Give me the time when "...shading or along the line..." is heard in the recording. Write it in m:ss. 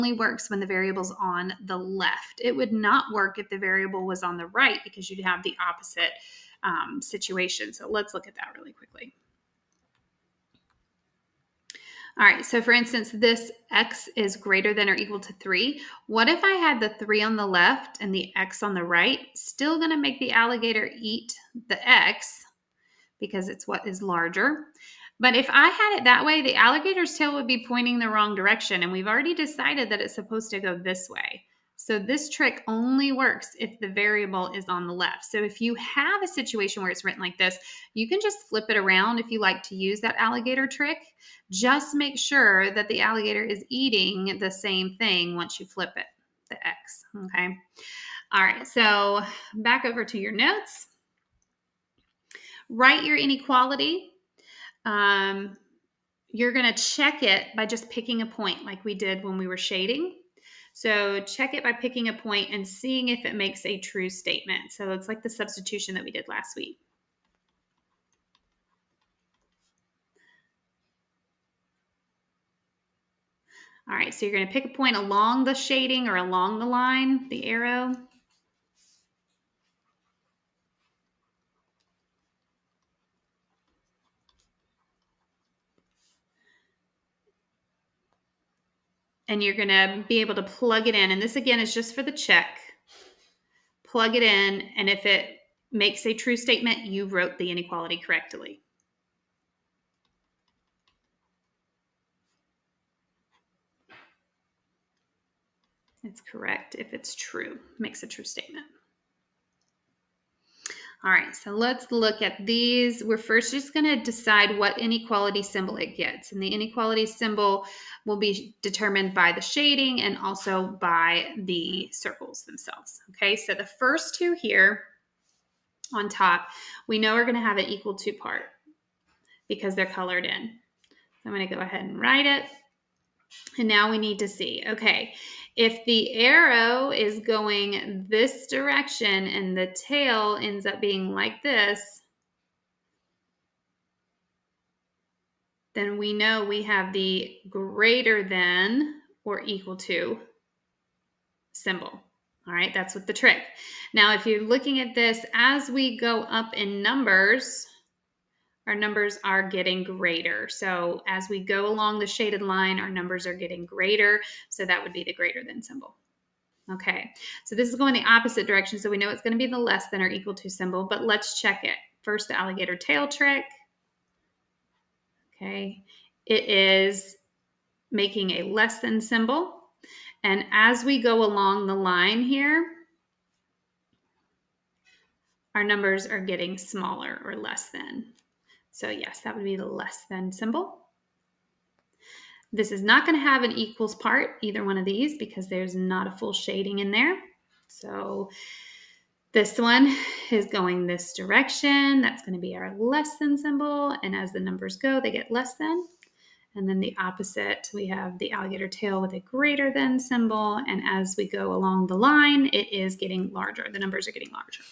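1:15.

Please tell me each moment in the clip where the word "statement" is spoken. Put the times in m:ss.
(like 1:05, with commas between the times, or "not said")
1:04, 1:36, 1:48.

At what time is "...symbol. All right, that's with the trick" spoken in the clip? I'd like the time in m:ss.
2:31.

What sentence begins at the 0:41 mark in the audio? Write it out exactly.
Just make sure that the alligator is eating the same thing once you flip it, the X, okay?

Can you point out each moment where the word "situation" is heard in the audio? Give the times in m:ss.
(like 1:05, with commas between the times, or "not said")
0:07, 0:36.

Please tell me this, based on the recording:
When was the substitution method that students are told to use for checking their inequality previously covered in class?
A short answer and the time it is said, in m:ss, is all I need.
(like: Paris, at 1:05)
last week, at 1:06.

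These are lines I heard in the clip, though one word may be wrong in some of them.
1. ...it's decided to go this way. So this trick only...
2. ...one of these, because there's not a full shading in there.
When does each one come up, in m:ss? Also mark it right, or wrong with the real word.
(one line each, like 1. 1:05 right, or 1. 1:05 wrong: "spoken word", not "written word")
1. 0:30 wrong: "supposed", not "decided"
2. 3:14 right.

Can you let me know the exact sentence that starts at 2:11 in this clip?
I'm going to go ahead and write it.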